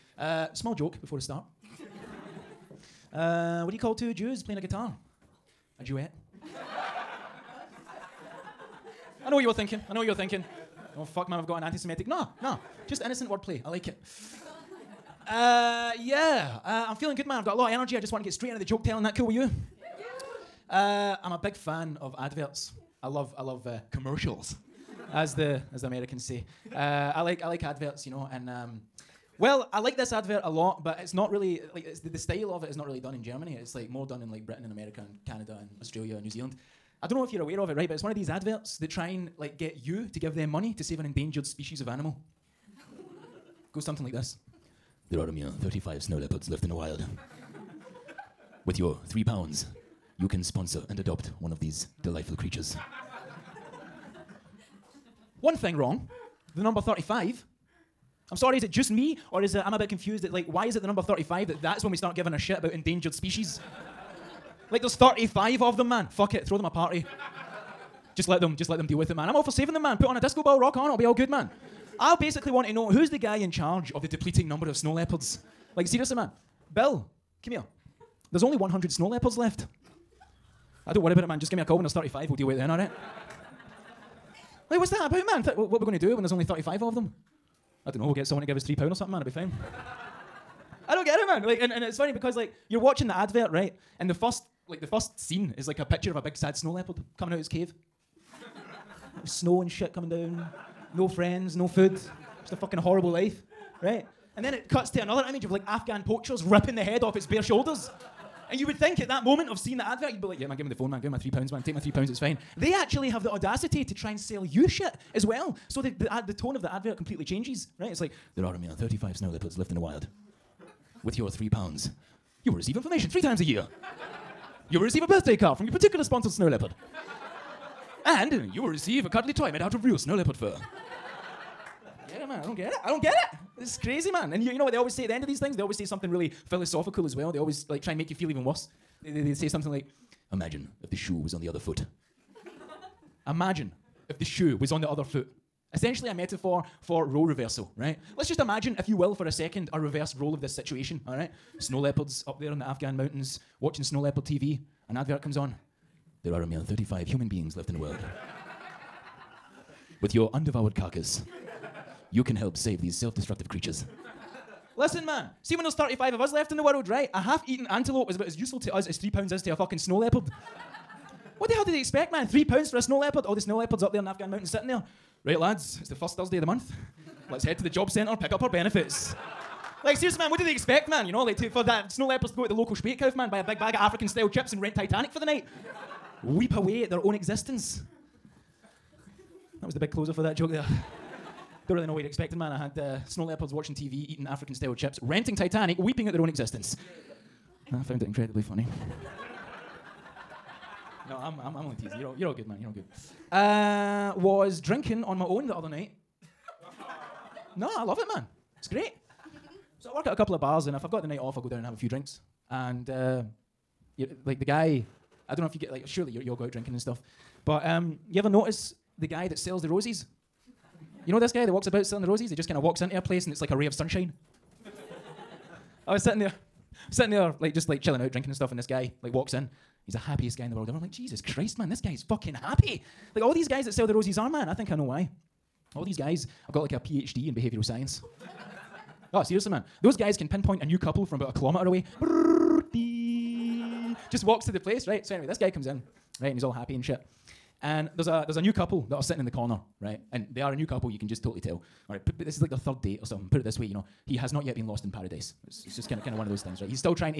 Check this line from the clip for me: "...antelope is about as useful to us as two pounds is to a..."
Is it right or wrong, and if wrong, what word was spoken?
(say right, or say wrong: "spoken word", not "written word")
wrong: "three", not "two".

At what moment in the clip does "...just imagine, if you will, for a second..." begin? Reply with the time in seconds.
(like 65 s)
148 s.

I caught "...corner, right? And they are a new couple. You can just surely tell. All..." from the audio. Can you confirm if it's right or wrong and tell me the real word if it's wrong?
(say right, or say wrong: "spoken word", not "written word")
wrong: "totally", not "surely".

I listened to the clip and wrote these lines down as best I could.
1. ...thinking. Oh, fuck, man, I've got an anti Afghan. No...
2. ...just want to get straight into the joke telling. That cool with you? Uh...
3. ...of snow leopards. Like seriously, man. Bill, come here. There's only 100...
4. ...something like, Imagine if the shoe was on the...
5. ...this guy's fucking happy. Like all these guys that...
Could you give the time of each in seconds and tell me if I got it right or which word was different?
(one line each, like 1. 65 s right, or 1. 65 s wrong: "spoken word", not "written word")
1. 10 s wrong: "Semitic", not "Afghan"
2. 17 s right
3. 74 s right
4. 139 s right
5. 231 s right.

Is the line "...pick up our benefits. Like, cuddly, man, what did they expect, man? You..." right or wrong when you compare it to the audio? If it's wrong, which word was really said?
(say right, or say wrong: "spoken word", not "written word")
wrong: "seriously", not "cuddly".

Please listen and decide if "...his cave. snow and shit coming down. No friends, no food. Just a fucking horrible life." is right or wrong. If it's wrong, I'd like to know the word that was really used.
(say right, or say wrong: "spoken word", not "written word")
right.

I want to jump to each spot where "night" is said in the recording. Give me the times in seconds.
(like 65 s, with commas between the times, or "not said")
185 s, 205 s, 211 s.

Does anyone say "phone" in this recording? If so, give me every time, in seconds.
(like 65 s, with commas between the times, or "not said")
110 s.